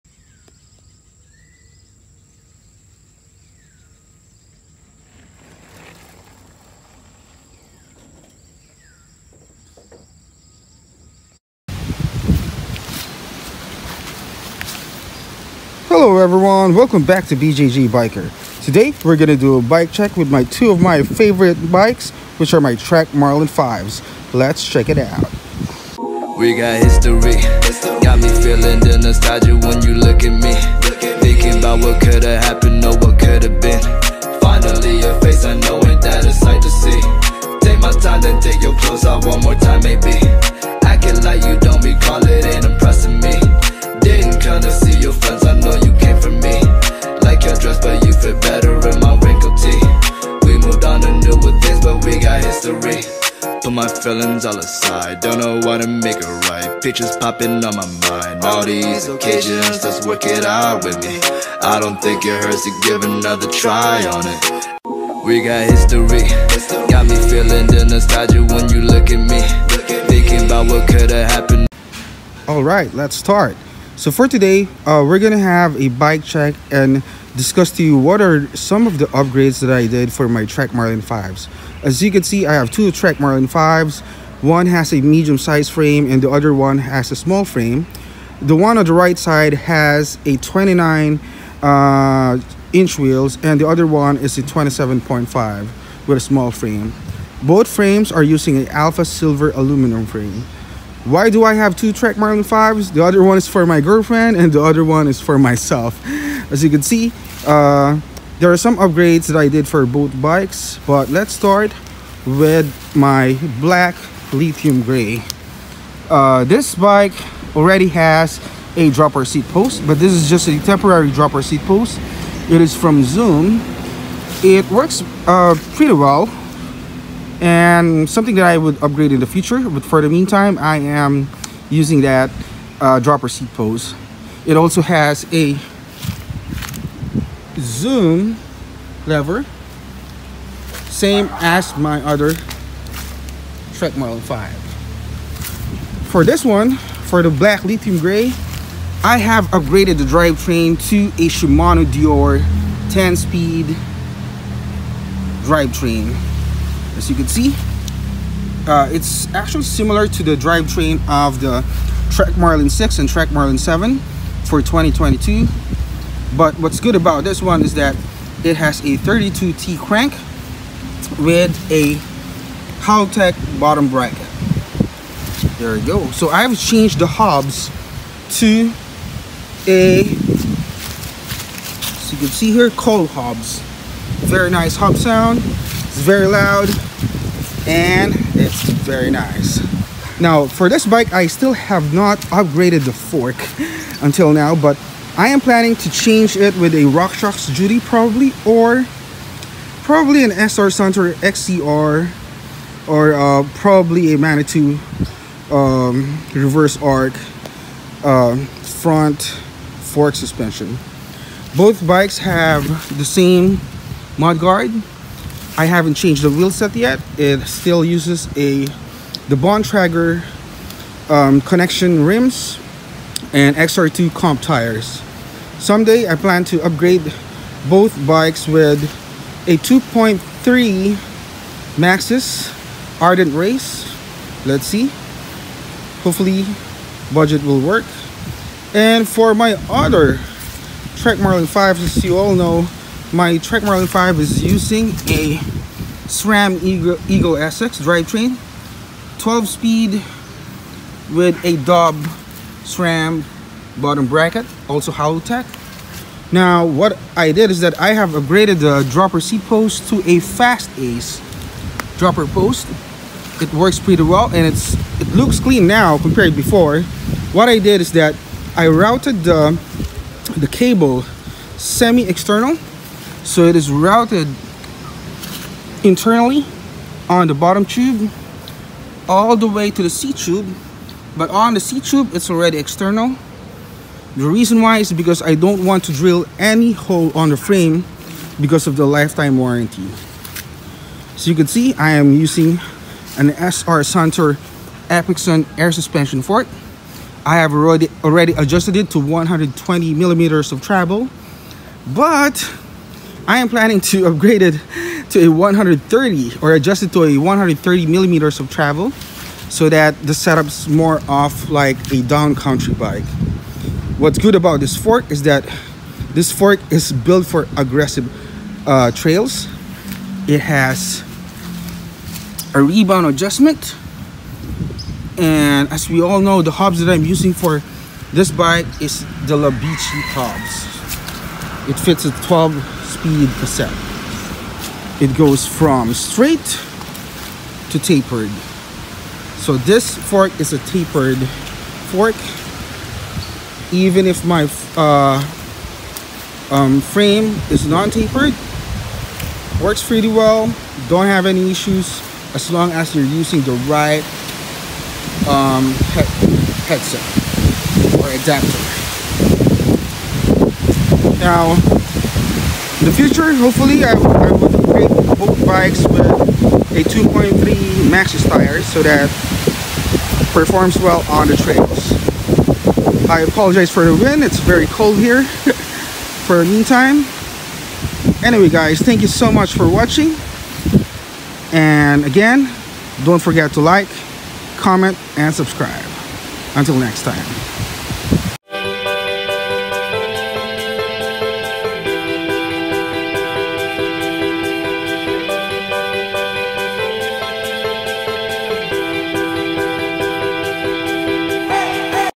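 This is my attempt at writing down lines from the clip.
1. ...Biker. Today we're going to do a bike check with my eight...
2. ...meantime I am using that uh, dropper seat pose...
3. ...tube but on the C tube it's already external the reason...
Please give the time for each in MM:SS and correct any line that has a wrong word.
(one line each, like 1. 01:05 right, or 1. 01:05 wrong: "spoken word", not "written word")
1. 00:17 wrong: "two", not "eight"
2. 02:10 right
3. 04:40 right.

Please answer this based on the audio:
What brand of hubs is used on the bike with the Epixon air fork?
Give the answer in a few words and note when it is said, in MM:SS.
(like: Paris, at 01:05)
Labici, at 05:29.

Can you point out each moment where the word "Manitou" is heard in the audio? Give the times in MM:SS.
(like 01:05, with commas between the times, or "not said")
03:24.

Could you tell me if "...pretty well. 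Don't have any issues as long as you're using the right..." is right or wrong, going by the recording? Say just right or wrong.
right.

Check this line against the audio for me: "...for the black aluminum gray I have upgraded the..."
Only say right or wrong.
wrong.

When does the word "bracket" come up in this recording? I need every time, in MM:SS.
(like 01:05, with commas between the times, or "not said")
02:53, 04:14.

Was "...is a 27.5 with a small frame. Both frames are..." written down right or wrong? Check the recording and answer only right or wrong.
right.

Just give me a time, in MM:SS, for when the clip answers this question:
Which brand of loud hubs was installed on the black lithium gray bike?
03:02.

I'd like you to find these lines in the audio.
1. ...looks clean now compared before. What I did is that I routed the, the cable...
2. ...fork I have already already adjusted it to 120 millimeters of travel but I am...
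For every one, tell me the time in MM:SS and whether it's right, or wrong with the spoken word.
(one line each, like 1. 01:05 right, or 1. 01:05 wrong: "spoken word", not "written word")
1. 04:25 right
2. 04:56 right.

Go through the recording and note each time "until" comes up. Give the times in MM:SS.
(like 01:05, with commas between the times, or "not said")
03:14, 06:26.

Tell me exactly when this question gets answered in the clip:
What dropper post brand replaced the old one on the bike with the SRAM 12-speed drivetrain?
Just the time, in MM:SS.
04:20.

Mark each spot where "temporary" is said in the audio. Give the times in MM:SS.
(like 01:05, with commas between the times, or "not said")
02:00.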